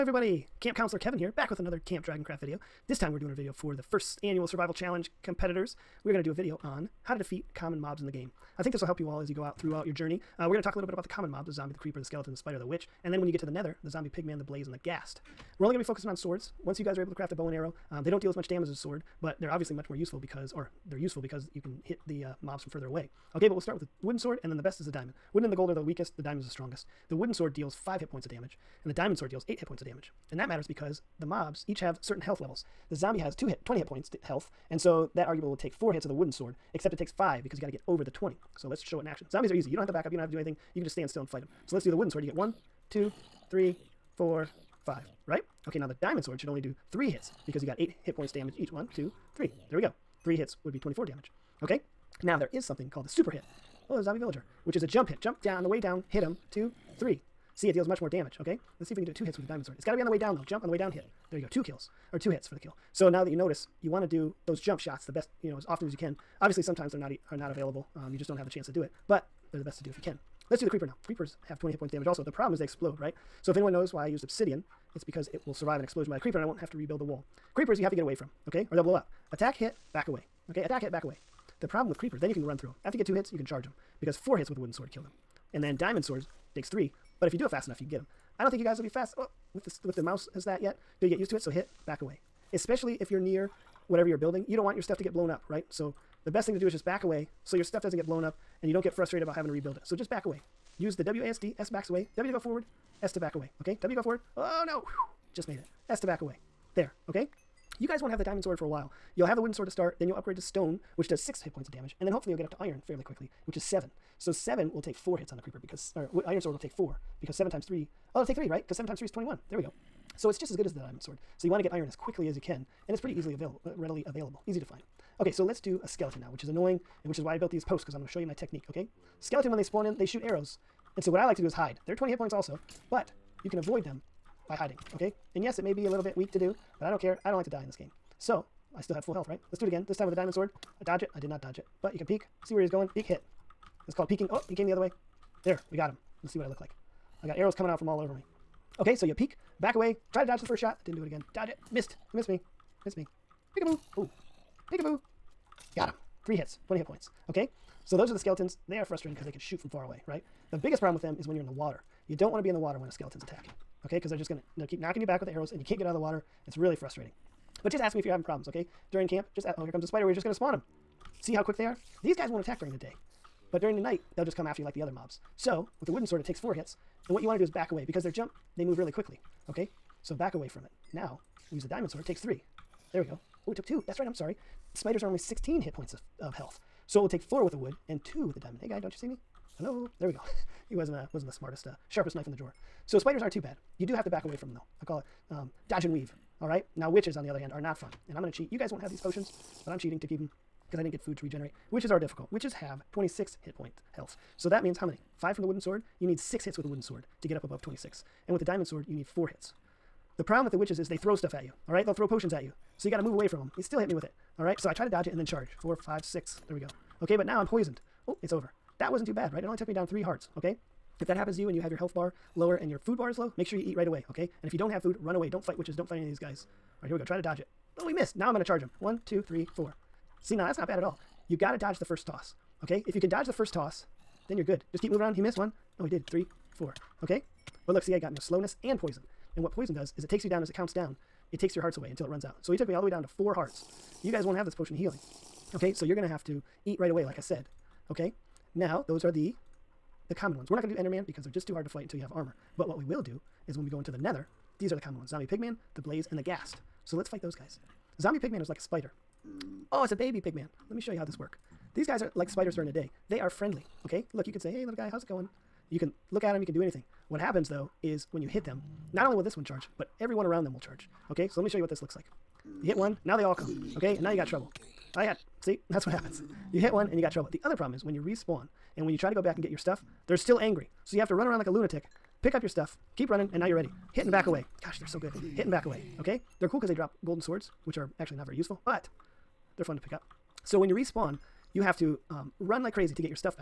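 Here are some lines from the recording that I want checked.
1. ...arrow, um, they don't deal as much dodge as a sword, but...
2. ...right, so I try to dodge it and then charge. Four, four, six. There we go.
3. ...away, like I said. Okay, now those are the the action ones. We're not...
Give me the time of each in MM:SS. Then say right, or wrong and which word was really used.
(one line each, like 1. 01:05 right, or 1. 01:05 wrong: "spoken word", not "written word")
1. 00:17 wrong: "damage", not "dodge"
2. 03:34 wrong: "five", not "four"
3. 04:06 wrong: "common", not "action".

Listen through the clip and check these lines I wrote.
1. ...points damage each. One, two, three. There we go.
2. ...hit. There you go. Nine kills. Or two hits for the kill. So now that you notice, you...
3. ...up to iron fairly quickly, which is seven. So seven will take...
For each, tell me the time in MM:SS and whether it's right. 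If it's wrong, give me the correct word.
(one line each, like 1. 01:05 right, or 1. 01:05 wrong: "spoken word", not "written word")
1. 00:48 right
2. 01:00 wrong: "Two", not "Nine"
3. 01:52 right.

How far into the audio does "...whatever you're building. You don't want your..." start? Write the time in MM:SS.
01:33.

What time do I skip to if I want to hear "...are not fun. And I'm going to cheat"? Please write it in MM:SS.
03:17.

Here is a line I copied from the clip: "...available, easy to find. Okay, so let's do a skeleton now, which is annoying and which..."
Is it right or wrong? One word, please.
right.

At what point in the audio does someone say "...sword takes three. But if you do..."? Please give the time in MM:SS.
01:26.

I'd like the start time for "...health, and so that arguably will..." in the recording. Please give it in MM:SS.
00:34.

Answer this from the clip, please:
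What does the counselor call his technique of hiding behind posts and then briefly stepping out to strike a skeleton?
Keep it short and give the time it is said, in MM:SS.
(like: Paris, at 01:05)
peeking, at 02:24.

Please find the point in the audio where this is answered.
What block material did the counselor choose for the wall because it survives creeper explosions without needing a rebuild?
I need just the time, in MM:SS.
01:14.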